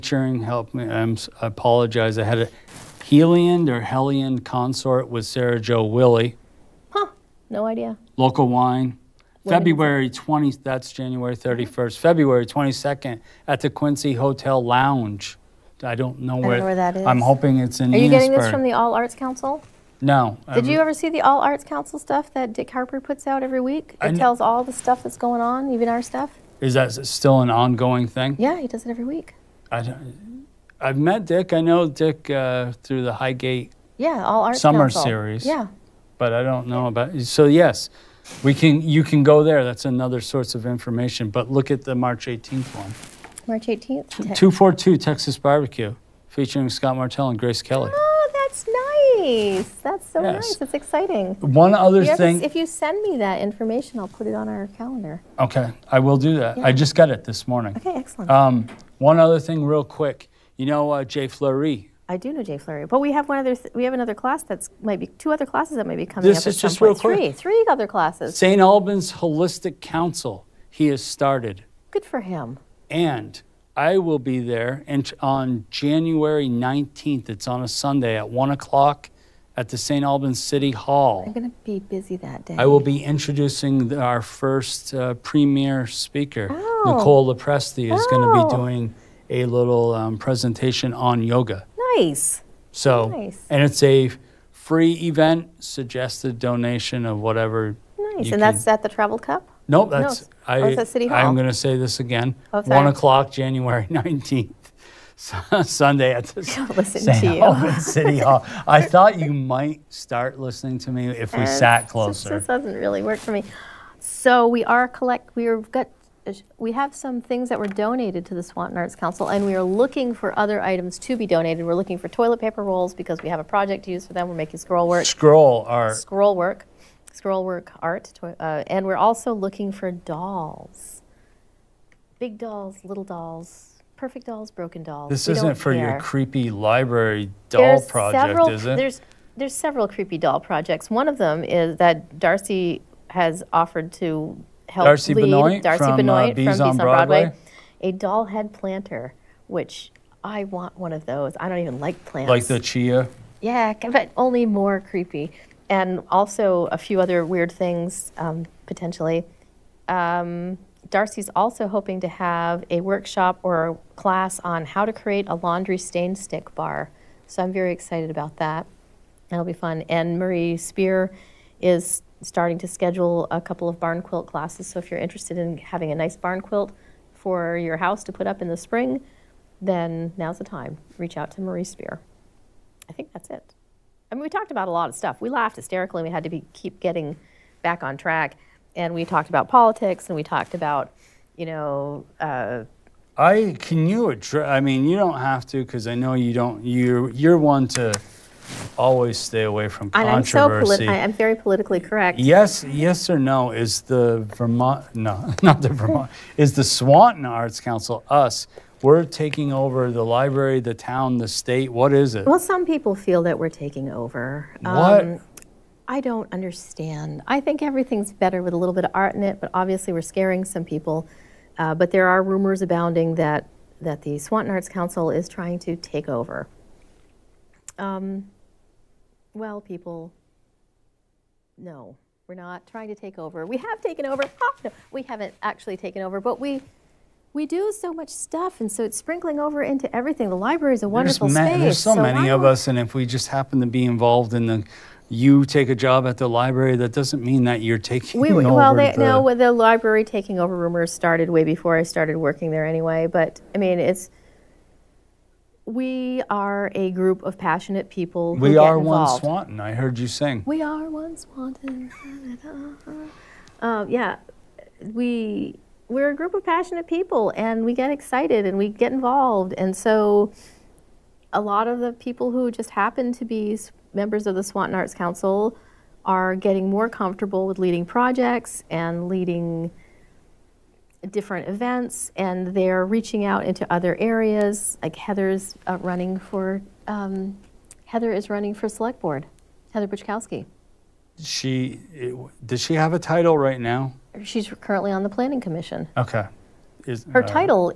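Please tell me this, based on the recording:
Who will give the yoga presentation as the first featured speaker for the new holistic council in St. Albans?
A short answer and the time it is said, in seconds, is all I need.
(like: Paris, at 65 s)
Nicole Lepresti, at 86 s.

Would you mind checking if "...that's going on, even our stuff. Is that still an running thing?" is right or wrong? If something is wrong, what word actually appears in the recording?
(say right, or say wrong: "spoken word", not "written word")
wrong: "ongoing", not "running".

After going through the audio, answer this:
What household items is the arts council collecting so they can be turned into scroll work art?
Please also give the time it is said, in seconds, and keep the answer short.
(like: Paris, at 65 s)
Toilet paper rolls, at 122 s.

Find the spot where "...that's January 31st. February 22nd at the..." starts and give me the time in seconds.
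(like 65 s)
10 s.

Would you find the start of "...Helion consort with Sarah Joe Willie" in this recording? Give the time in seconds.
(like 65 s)
3 s.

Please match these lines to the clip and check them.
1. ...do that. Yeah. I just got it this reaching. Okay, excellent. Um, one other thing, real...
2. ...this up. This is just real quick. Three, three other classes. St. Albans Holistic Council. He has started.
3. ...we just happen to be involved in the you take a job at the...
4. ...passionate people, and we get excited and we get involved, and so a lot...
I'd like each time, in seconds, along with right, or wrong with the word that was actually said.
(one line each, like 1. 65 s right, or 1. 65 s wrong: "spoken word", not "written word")
1. 56 s wrong: "morning", not "reaching"
2. 66 s right
3. 242 s right
4. 266 s right.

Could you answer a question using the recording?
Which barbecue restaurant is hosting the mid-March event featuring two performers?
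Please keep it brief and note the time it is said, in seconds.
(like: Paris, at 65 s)
242 Texas Barbecue, at 44 s.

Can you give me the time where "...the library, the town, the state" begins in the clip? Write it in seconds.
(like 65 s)
209 s.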